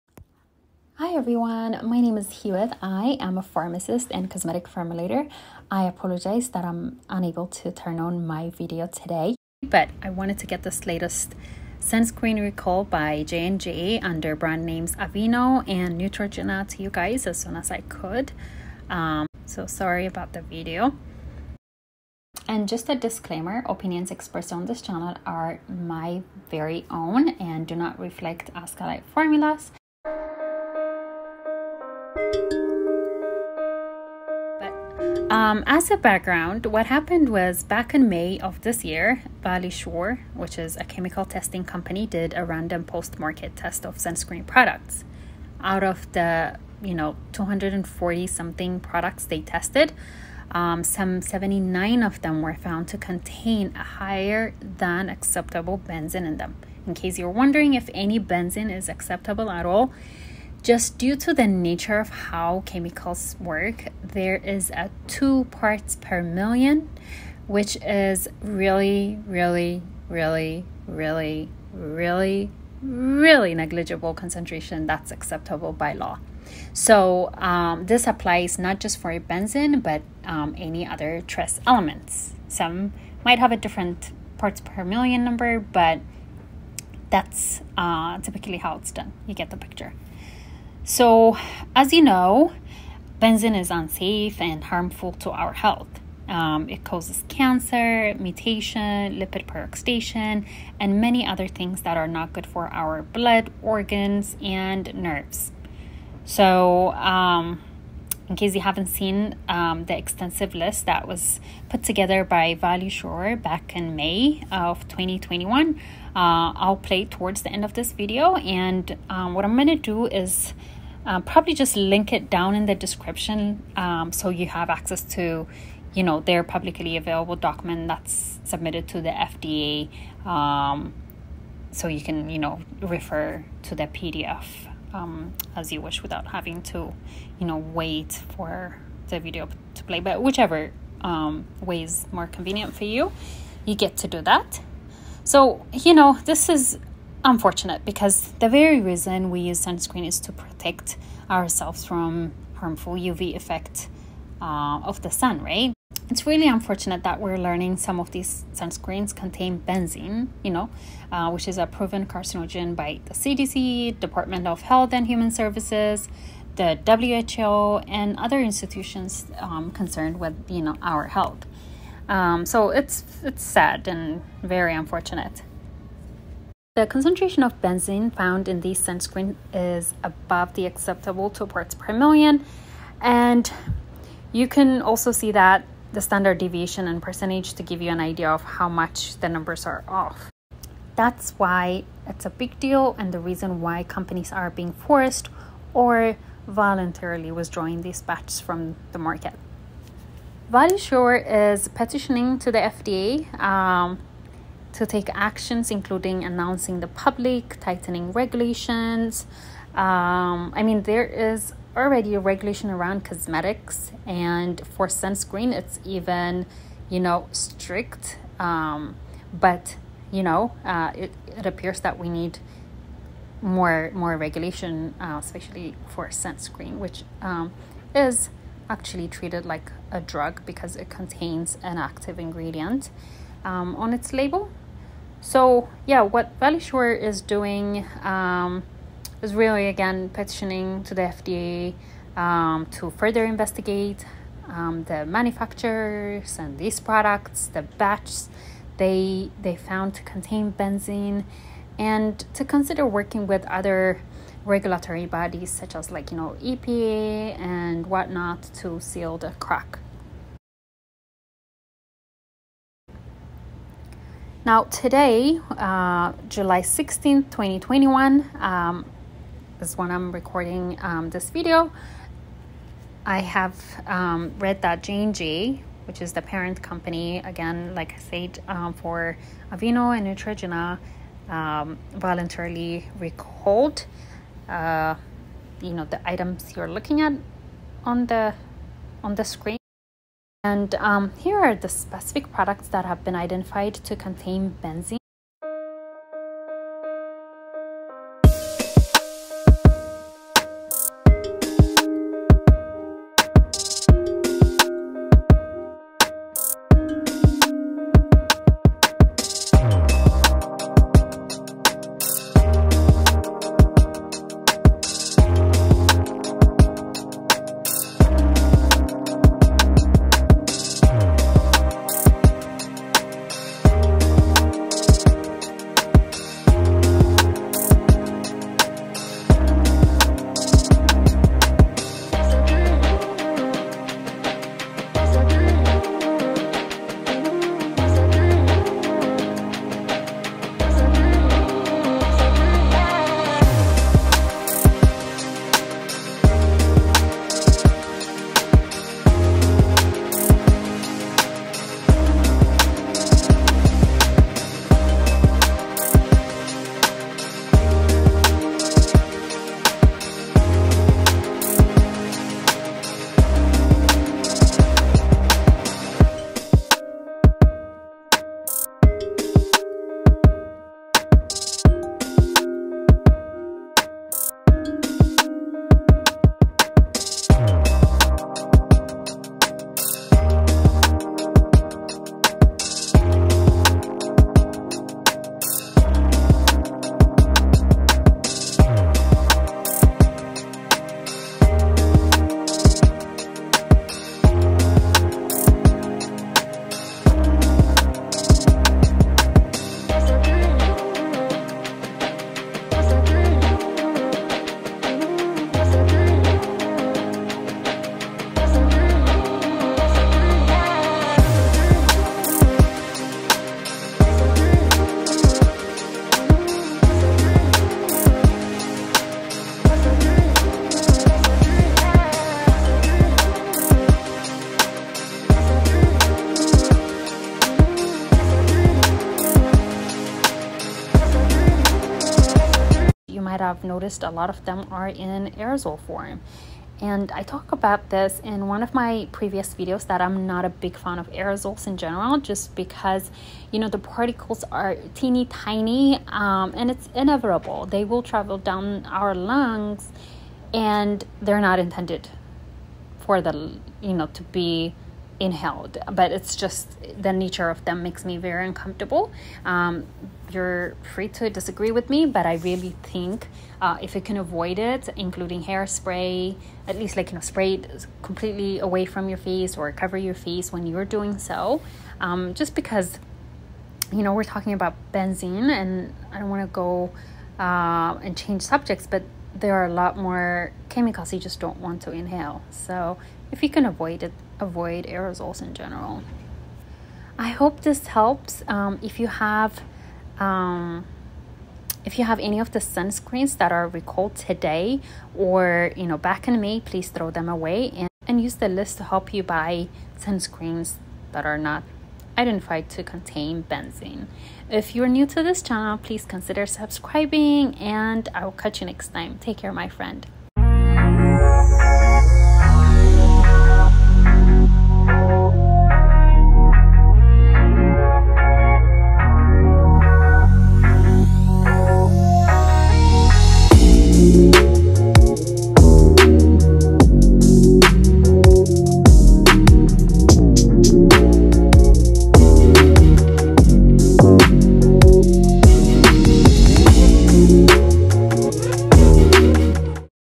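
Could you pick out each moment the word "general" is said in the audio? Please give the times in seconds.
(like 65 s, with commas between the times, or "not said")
441 s, 485 s.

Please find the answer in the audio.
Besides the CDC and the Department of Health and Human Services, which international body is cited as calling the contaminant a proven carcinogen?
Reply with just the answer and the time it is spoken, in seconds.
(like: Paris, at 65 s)
WHO, at 166 s.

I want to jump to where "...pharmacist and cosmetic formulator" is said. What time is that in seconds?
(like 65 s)
3 s.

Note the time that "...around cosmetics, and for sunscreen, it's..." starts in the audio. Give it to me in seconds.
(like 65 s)
212 s.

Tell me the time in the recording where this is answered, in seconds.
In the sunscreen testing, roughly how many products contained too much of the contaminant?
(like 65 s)
51 s.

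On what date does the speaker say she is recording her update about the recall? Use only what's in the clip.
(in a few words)
July 16th, 2021.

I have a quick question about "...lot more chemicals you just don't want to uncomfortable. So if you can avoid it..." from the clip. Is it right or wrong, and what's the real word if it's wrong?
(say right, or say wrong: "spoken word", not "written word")
wrong: "inhale", not "uncomfortable".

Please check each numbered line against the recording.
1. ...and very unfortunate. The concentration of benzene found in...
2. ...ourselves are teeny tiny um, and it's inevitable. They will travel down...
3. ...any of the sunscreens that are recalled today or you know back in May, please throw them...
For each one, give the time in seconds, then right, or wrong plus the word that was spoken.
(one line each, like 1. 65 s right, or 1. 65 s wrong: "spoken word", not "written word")
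1. 173 s right
2. 443 s wrong: "particles", not "ourselves"
3. 492 s right.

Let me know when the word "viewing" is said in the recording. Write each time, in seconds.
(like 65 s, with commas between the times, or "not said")
not said.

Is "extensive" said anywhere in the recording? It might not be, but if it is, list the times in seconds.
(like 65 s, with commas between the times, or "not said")
109 s.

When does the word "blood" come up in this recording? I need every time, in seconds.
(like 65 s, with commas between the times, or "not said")
103 s.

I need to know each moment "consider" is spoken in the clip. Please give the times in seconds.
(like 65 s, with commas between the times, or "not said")
252 s, 506 s.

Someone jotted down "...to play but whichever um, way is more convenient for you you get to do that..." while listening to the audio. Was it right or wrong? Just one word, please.
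right.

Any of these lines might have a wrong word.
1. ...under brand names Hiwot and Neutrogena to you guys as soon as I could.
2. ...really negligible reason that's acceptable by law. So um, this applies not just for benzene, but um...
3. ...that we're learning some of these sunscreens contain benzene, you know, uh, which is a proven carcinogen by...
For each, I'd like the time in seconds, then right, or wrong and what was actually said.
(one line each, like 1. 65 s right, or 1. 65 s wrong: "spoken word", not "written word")
1. 14 s wrong: "Aveeno", not "Hiwot"
2. 72 s wrong: "concentration", not "reason"
3. 157 s right.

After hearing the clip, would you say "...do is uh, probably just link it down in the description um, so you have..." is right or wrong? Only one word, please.
right.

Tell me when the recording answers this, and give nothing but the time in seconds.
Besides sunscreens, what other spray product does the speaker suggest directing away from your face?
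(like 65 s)
465 s.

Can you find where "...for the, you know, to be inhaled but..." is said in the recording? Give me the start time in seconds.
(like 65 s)
453 s.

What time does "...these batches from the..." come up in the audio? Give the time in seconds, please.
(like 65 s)
197 s.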